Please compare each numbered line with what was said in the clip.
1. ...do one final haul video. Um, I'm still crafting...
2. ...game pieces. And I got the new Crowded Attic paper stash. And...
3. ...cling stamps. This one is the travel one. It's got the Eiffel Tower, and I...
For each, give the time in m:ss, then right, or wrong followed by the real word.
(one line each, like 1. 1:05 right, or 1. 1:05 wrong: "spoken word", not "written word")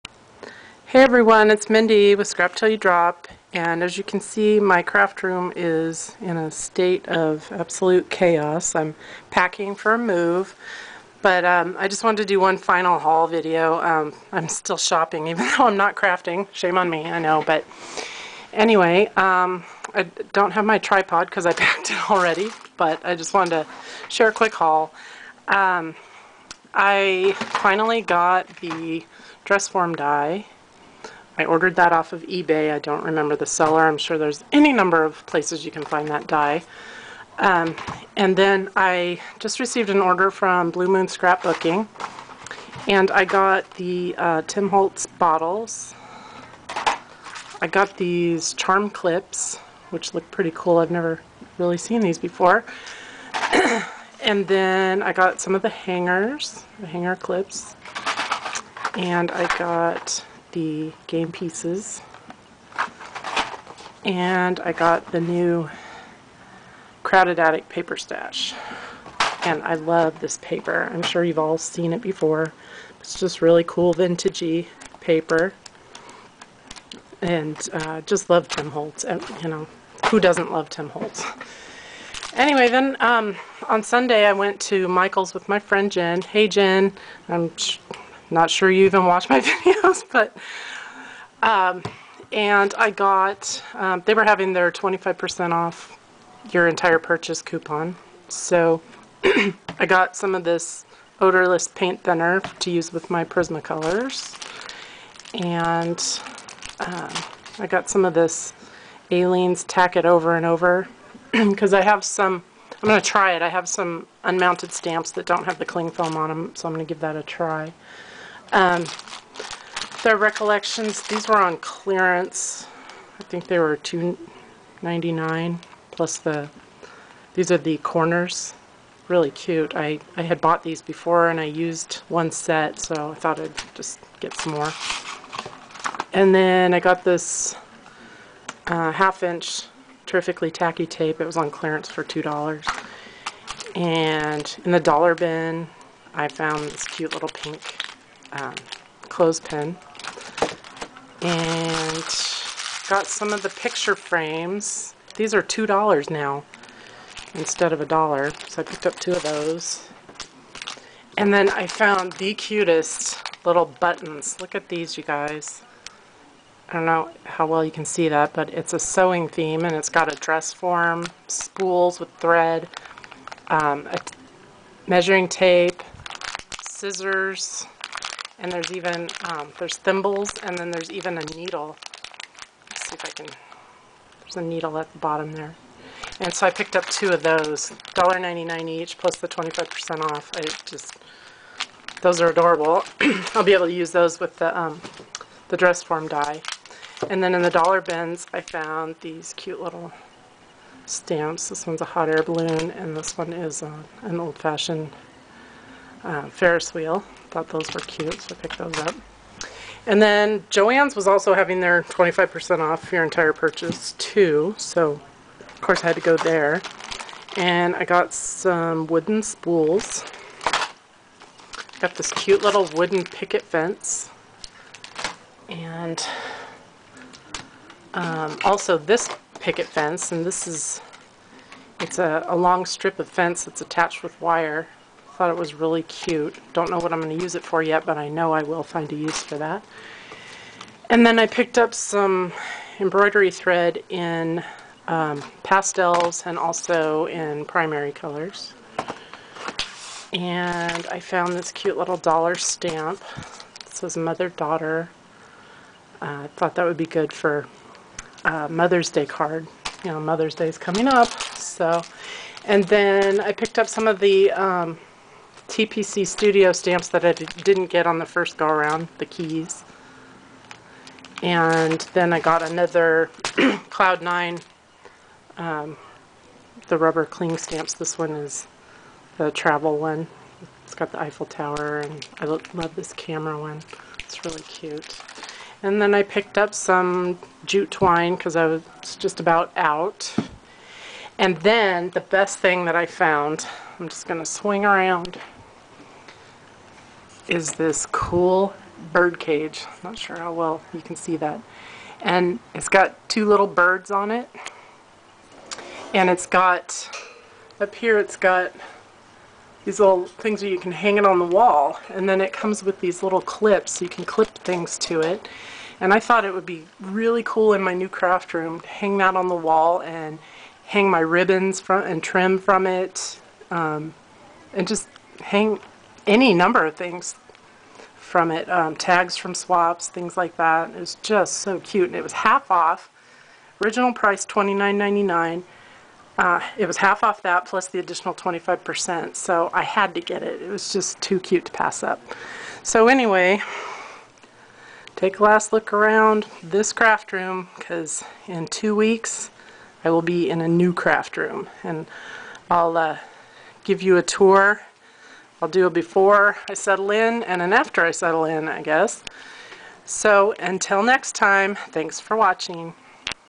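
1. 0:12 wrong: "shopping", not "crafting"
2. 1:01 right
3. 4:37 right.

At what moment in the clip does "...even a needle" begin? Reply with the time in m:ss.
3:00.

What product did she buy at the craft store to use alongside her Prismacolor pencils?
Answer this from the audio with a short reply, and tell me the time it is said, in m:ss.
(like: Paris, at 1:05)
odorless paint thinner, at 1:41.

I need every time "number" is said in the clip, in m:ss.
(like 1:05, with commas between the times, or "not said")
0:34, 5:26.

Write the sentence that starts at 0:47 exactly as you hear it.
I got these charm clips, which look pretty cool.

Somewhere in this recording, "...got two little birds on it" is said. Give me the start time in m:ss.
5:02.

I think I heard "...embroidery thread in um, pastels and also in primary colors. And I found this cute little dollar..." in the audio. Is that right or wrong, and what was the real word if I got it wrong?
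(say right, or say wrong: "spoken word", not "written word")
right.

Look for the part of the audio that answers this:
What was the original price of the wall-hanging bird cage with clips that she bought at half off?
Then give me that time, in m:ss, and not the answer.
5:34.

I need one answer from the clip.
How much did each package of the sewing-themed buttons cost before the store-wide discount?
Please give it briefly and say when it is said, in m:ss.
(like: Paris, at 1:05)
$1.99, at 3:07.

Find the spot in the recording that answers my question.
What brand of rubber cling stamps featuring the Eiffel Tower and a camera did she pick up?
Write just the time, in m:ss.
4:33.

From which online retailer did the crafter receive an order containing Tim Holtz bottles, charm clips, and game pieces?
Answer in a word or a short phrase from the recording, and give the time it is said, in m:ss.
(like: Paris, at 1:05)
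Blue Moon Scrapbooking, at 0:40.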